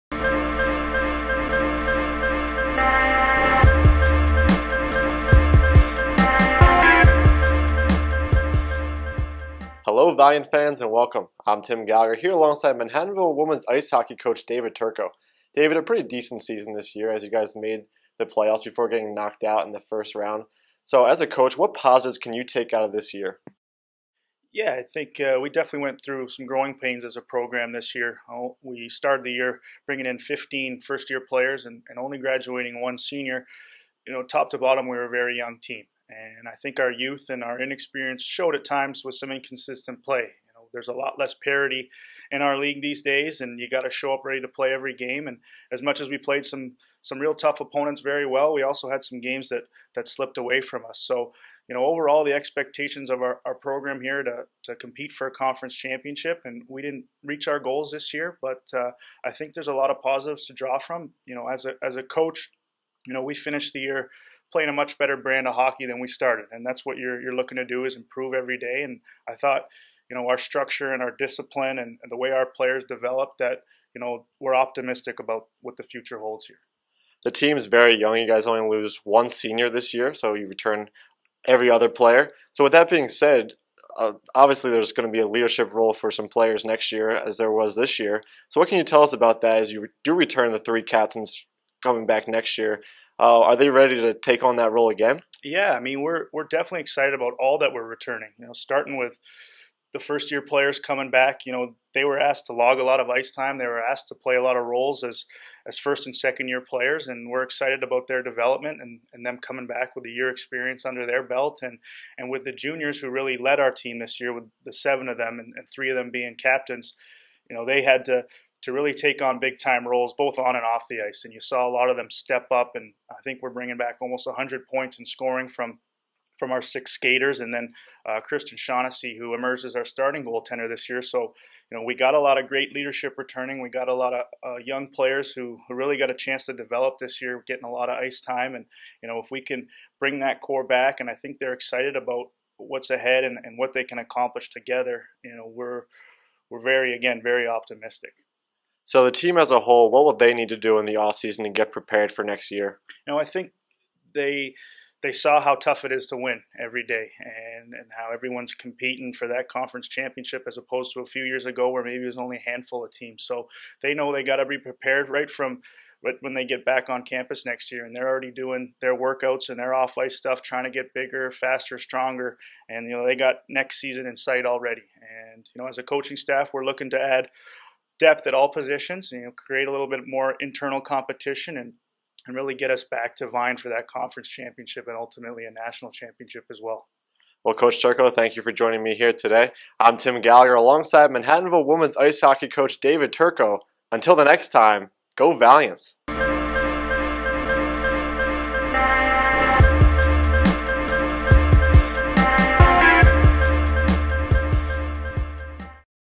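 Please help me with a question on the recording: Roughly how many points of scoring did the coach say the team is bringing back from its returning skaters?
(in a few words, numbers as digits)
almost 100.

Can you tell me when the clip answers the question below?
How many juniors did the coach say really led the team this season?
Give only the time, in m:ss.
1:54.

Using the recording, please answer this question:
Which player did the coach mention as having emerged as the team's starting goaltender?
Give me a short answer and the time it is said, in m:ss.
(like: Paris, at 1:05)
Kristen Shaughnessy, at 2:08.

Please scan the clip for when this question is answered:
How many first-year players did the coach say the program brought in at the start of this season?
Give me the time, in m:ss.
0:30.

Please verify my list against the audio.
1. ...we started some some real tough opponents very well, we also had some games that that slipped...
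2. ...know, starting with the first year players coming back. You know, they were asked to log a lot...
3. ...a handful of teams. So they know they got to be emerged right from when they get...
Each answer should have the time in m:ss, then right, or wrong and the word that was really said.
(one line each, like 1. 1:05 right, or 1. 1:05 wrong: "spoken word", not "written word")
1. 0:46 wrong: "played", not "started"
2. 1:38 right
3. 2:42 wrong: "prepared", not "emerged".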